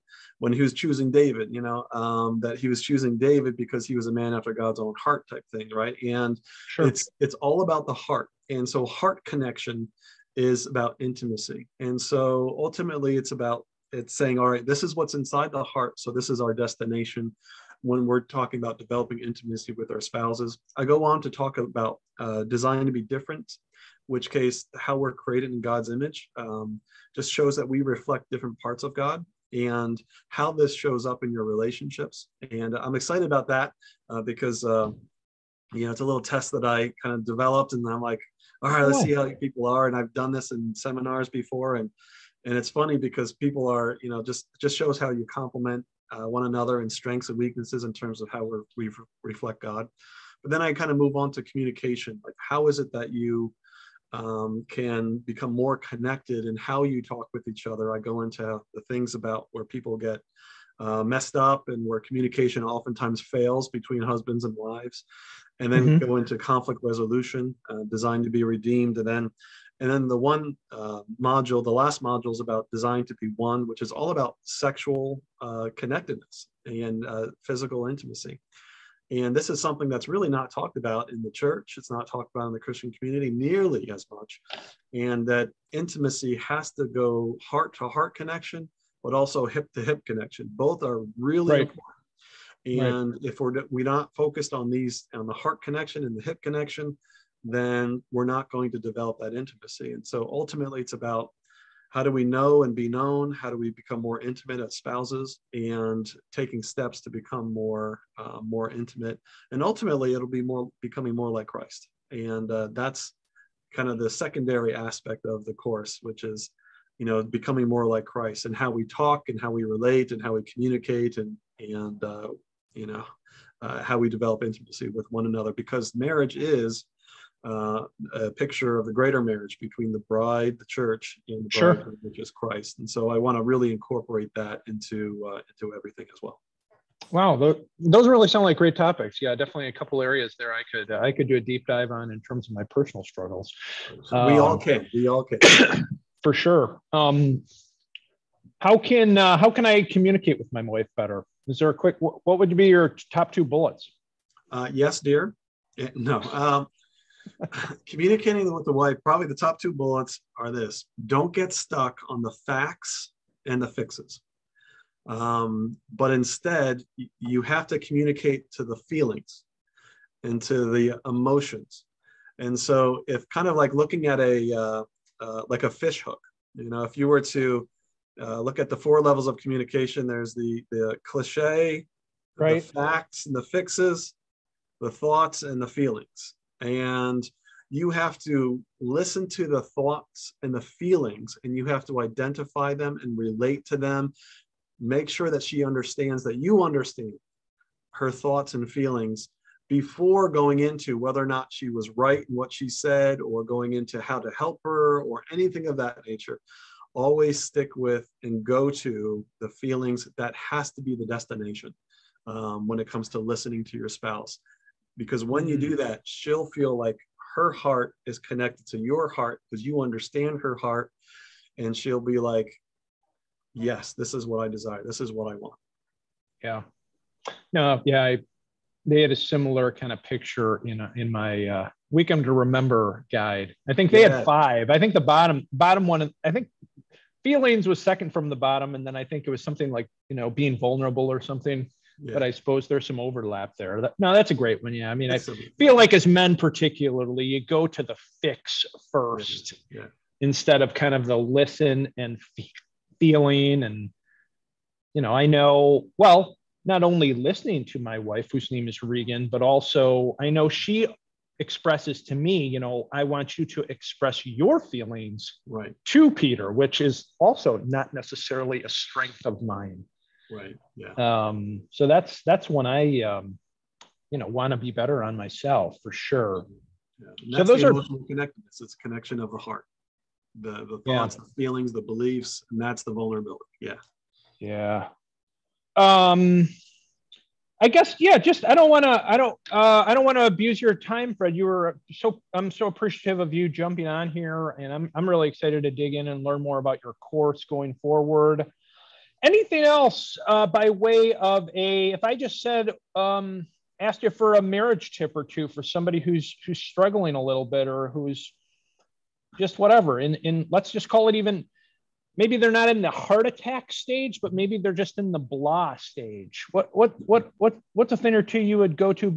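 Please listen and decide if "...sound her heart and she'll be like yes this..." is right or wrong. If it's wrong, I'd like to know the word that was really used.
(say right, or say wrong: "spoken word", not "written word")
wrong: "understand", not "sound".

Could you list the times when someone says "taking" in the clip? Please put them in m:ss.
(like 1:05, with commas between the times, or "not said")
1:46.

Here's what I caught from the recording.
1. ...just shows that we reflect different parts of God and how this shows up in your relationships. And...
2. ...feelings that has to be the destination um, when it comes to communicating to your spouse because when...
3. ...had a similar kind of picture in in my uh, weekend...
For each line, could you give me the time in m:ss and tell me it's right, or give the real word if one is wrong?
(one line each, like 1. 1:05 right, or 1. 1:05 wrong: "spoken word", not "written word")
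1. 0:27 right
2. 3:29 wrong: "listening", not "communicating"
3. 3:49 right.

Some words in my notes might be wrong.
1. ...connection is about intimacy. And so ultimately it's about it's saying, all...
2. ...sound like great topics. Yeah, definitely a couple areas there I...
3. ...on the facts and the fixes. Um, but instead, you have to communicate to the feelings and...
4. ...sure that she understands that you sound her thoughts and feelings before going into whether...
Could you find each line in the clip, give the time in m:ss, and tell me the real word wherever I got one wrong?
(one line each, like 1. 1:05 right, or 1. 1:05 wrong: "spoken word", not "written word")
1. 0:09 right
2. 2:18 right
3. 2:42 right
4. 3:15 wrong: "understand", not "sound".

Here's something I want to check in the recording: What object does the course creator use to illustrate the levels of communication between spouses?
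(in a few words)
Fish hook.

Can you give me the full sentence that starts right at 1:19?
And this is something that's really not talked about in the church.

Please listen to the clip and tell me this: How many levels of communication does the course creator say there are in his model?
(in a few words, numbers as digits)
4.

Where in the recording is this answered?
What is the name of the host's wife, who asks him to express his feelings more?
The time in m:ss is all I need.
4:18.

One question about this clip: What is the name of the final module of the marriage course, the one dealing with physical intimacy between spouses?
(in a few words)
Design to be one.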